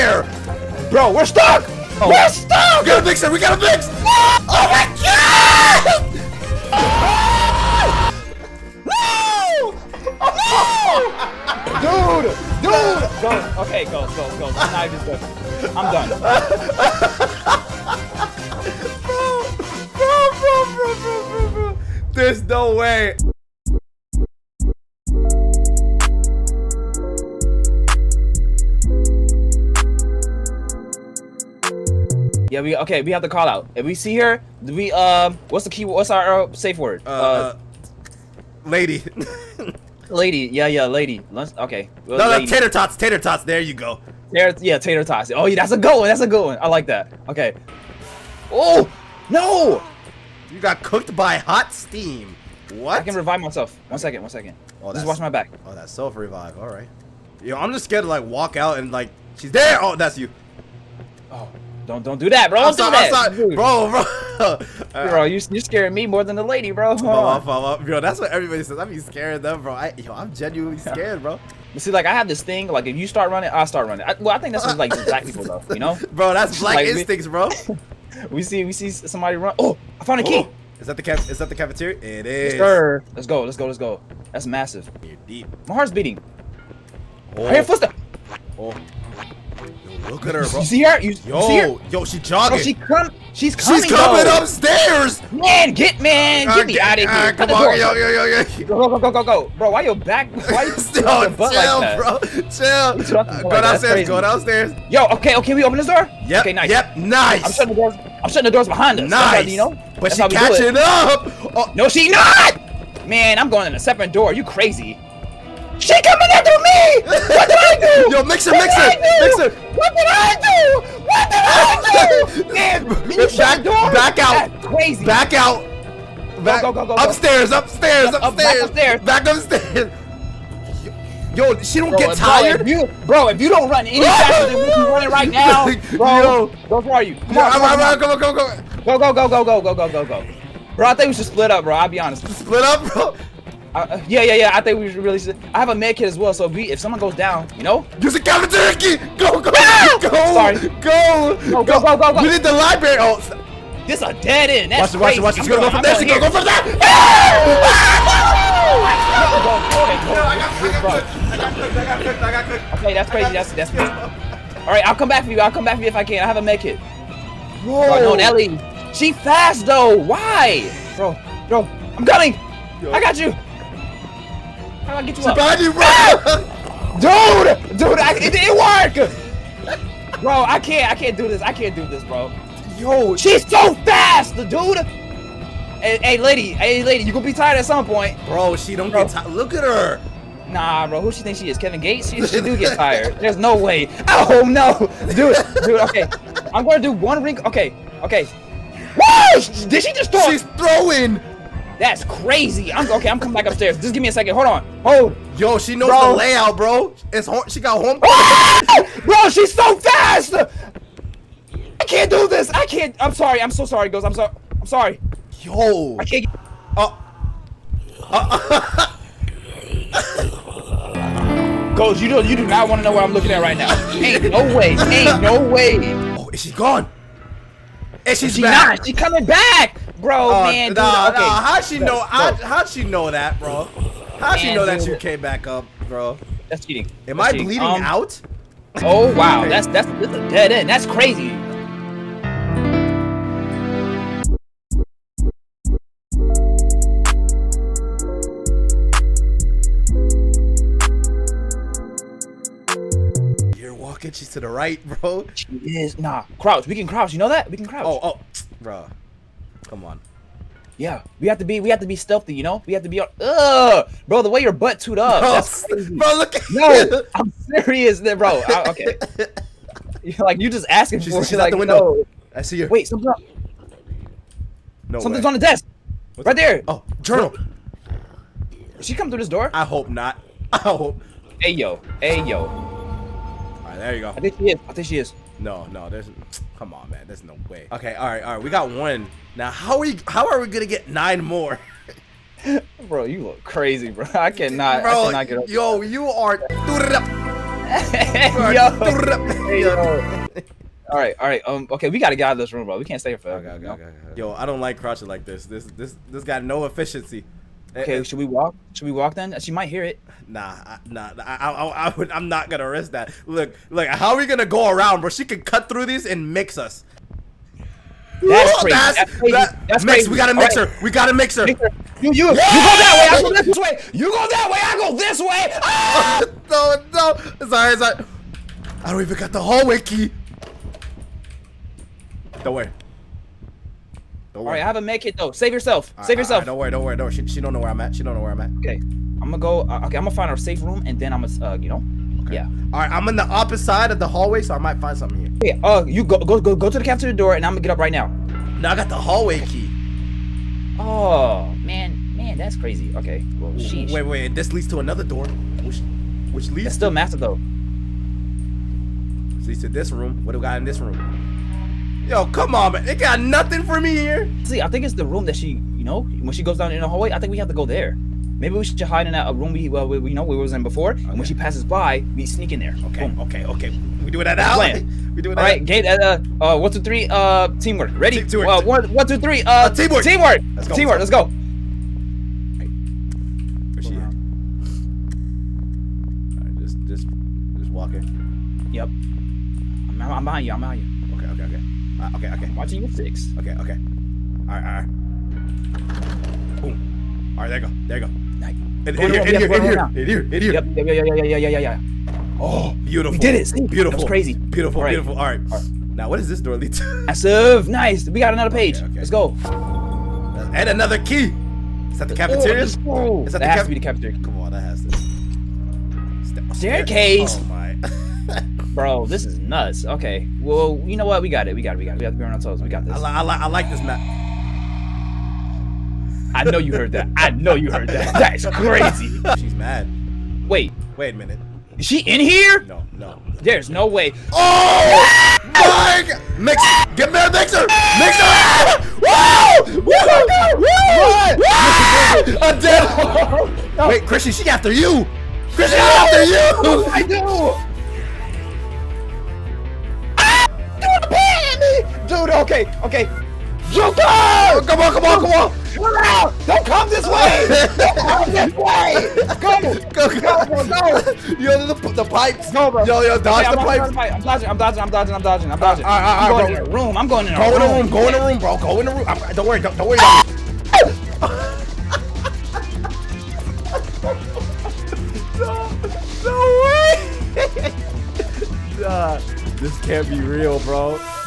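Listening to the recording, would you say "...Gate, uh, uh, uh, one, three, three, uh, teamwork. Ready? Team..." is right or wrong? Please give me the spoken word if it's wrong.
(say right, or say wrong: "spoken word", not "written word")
wrong: "two", not "three".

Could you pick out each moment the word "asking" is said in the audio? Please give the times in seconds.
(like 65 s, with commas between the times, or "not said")
270 s.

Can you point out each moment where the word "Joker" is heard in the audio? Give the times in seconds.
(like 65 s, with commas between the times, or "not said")
453 s.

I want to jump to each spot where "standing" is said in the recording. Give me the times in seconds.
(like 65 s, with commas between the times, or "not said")
not said.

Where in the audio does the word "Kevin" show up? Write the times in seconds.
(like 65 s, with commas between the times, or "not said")
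191 s.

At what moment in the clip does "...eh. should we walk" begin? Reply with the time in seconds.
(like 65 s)
307 s.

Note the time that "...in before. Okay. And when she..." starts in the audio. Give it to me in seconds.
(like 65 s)
370 s.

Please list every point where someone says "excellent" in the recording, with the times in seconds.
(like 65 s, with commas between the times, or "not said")
not said.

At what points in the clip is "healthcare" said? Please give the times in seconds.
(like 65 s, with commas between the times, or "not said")
not said.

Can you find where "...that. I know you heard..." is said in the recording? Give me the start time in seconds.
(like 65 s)
426 s.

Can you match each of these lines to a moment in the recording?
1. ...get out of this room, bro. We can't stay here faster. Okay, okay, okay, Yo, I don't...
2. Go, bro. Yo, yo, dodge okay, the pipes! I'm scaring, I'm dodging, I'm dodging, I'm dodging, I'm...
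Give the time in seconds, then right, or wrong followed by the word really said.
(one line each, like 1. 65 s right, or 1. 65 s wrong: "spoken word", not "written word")
1. 302 s wrong: "forever", not "faster"
2. 462 s wrong: "dodging", not "scaring".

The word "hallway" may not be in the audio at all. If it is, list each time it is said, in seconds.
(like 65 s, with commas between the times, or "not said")
329 s, 344 s, 348 s, 366 s.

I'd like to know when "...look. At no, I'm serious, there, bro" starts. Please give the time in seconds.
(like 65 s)
266 s.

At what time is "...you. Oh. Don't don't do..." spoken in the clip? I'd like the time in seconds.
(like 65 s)
60 s.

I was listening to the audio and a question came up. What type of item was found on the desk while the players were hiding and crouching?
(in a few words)
journal.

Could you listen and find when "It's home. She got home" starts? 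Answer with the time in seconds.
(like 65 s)
207 s.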